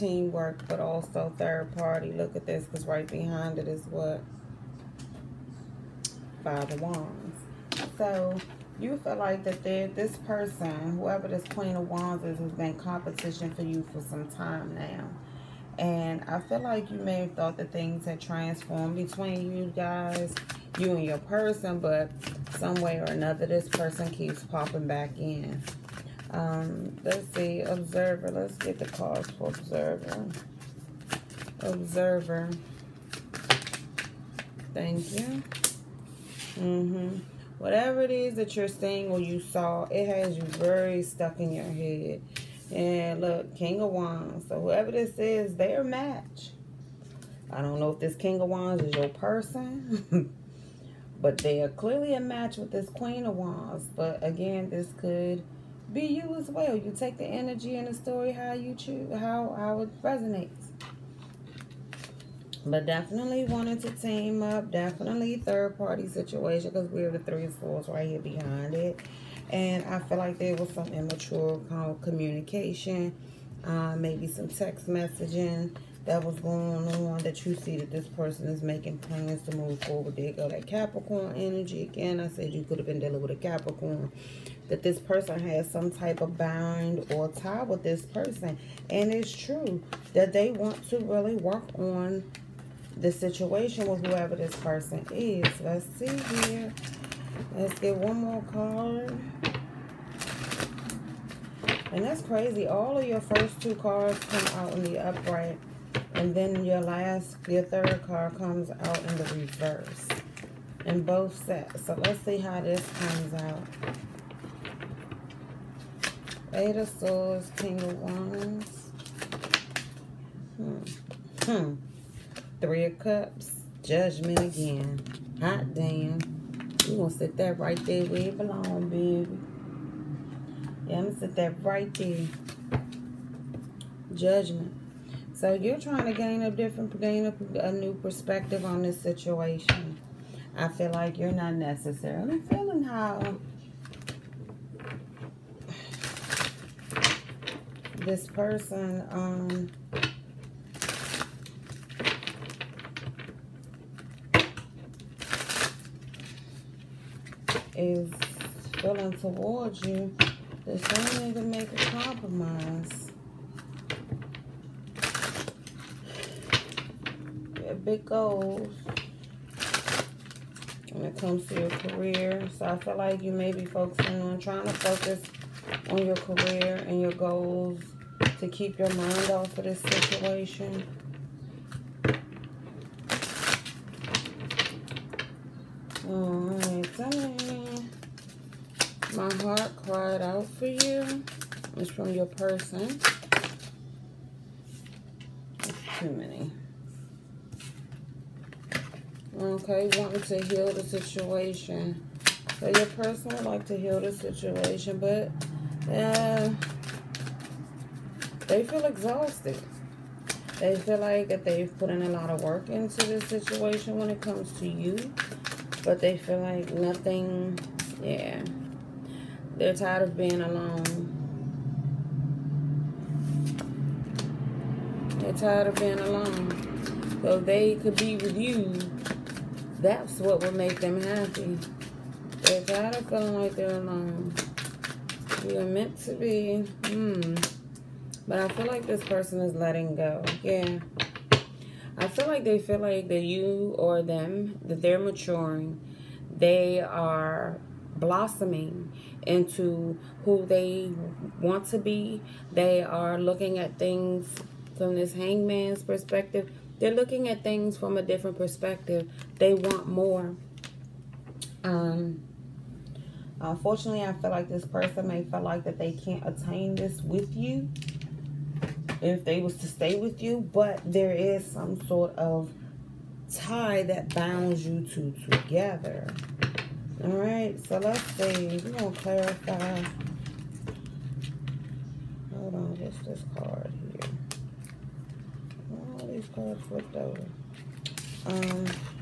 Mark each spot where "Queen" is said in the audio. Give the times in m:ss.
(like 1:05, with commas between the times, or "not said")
0:11, 0:52.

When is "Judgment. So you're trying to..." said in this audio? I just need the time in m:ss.
2:14.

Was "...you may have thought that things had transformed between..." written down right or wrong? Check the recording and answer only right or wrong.
right.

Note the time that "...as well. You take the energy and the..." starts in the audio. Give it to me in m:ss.
0:56.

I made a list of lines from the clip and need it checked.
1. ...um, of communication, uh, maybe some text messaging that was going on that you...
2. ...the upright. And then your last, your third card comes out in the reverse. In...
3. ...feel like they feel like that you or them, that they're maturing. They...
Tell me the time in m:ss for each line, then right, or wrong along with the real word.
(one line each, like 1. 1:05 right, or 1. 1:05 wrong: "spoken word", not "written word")
1. 1:11 right
2. 1:44 right
3. 4:02 right.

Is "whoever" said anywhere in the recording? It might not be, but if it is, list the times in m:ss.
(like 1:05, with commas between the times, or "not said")
0:10, 0:44, 1:34.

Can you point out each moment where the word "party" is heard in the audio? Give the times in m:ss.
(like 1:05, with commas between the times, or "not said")
0:01, 1:05.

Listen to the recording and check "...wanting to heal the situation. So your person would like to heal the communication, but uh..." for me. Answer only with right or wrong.
wrong.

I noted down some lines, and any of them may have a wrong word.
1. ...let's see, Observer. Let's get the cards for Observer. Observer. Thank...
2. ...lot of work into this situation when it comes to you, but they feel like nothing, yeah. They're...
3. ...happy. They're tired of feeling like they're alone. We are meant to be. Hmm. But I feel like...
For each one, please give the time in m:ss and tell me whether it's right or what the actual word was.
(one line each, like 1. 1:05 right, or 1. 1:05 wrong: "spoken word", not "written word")
1. 0:27 right
2. 3:32 right
3. 3:51 right.